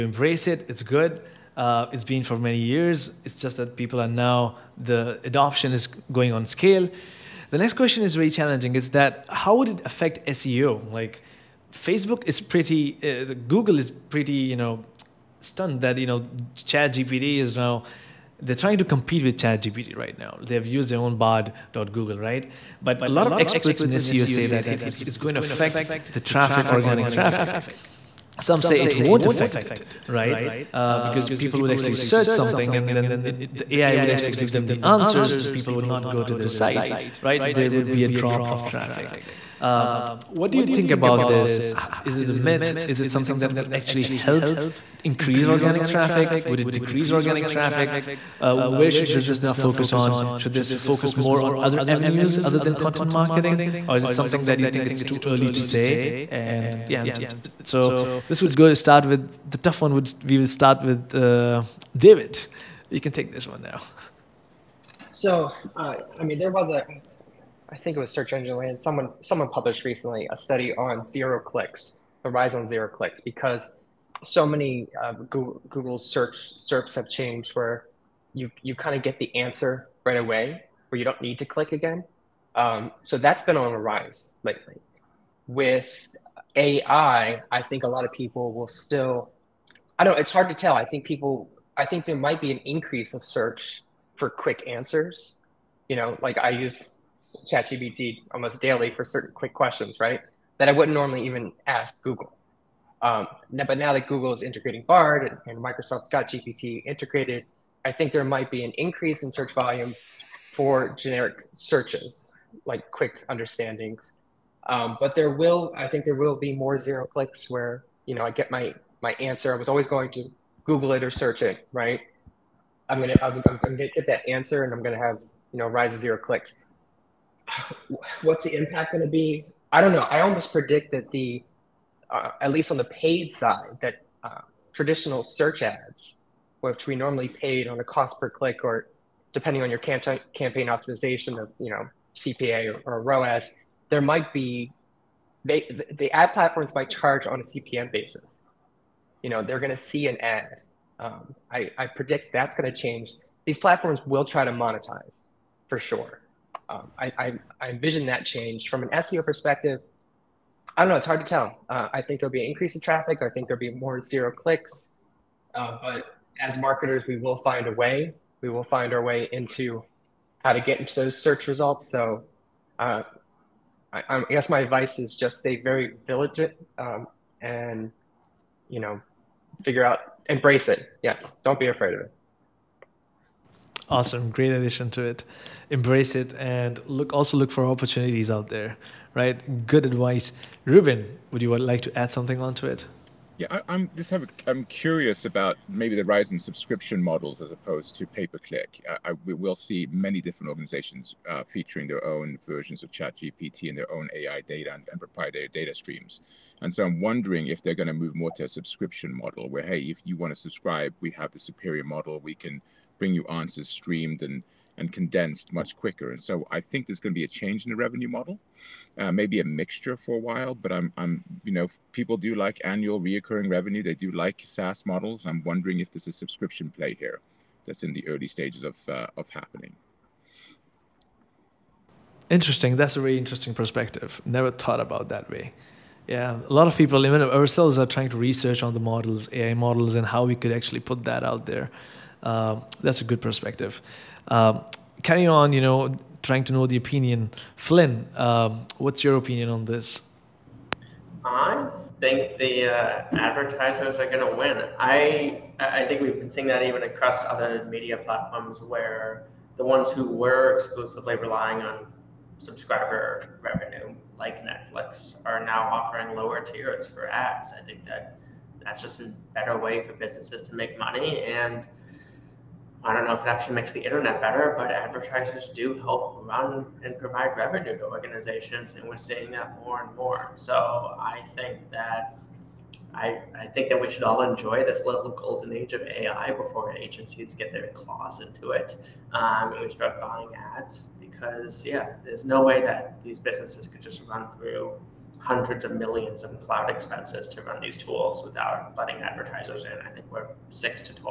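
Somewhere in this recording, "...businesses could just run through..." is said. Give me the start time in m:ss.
4:53.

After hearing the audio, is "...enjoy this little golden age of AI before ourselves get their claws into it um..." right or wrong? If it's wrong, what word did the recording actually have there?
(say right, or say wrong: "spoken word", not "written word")
wrong: "agencies", not "ourselves".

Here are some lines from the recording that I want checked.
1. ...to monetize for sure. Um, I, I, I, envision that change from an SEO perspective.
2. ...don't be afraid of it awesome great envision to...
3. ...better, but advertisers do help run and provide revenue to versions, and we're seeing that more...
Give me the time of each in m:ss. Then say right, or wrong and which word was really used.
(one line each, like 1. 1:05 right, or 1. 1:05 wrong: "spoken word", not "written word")
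1. 2:34 right
2. 3:01 wrong: "addition", not "envision"
3. 4:34 wrong: "organizations", not "versions".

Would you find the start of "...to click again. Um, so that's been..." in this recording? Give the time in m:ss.
1:21.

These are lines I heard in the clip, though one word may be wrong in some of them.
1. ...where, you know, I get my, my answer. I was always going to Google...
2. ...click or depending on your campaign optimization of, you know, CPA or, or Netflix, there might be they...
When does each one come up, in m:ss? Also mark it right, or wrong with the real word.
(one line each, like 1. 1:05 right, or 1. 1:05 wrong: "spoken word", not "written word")
1. 1:57 right
2. 2:18 wrong: "ROAS", not "Netflix".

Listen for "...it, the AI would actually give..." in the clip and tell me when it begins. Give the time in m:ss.
0:33.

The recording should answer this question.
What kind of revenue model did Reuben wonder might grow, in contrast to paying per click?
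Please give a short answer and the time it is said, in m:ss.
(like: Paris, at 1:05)
Subscription models, at 3:16.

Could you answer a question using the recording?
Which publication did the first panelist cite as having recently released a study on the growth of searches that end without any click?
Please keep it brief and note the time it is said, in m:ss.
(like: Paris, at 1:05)
Search Engine Land, at 1:08.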